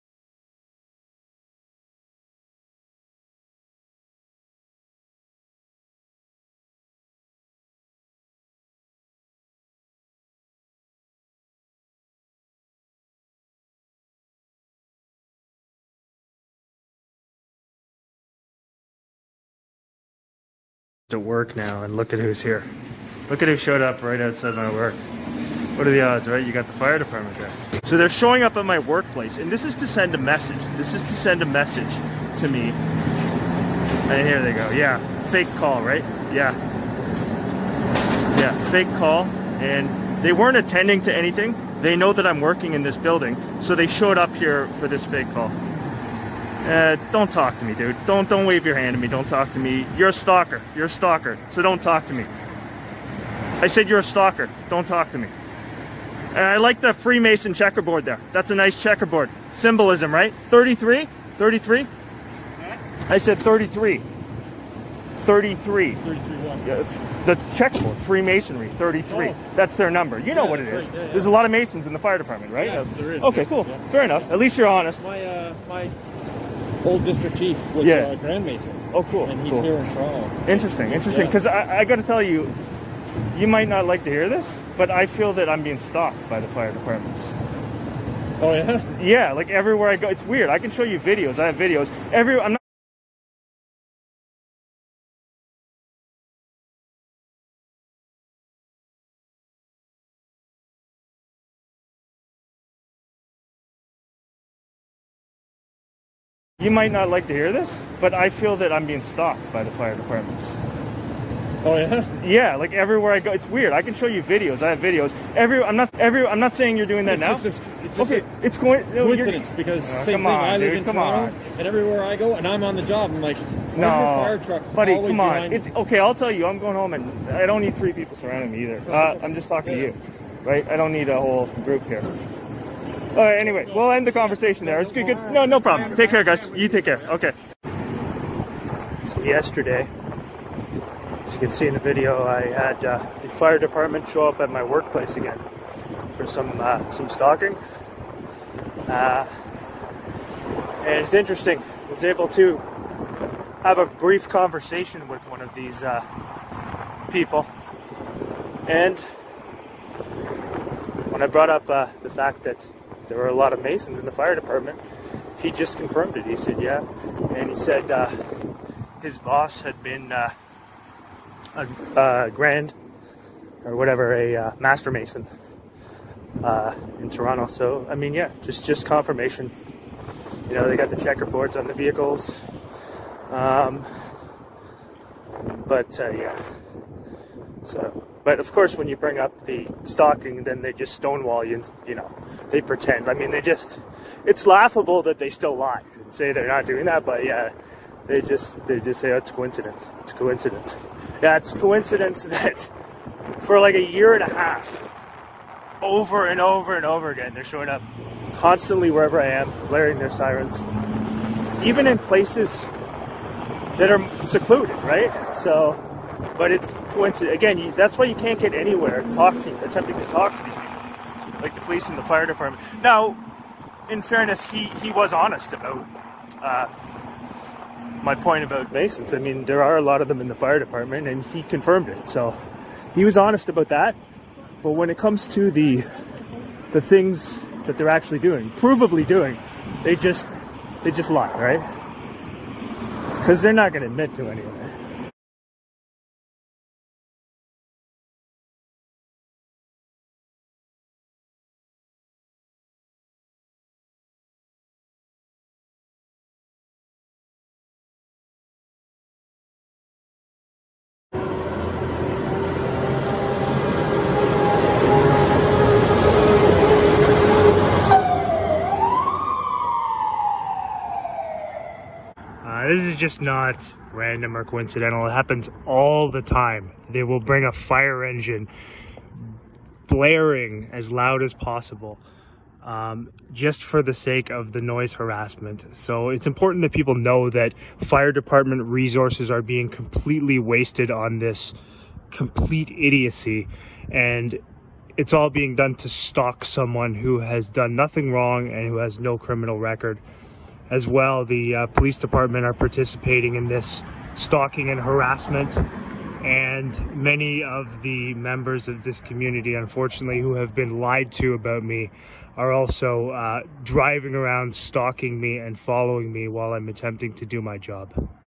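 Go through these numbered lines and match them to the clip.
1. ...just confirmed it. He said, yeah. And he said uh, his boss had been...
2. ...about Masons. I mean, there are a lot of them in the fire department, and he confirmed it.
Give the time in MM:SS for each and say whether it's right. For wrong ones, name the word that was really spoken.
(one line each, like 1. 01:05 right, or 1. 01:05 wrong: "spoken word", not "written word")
1. 02:45 right
2. 03:48 right.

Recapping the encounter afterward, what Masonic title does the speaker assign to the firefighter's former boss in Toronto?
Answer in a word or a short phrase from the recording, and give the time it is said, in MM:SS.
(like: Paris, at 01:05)
Master Mason, at 02:54.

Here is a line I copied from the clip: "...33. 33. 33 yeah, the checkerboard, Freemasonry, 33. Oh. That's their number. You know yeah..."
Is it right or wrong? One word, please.
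right.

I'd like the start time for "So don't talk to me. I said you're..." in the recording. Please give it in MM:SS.
00:51.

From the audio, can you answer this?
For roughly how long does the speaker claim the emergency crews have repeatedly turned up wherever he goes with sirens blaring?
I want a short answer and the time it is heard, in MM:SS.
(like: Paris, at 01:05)
A year and a half, at 03:23.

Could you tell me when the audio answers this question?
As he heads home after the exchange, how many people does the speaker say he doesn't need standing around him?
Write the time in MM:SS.
02:07.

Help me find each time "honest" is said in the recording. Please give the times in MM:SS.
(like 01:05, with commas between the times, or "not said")
01:14, 03:45, 03:53.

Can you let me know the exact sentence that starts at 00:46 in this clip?
Uh, don't talk to me, dude.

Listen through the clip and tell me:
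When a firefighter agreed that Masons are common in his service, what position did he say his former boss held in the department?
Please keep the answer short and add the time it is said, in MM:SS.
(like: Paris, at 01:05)
District chief, at 01:17.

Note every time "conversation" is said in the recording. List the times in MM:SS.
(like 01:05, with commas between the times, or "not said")
02:14, 02:34.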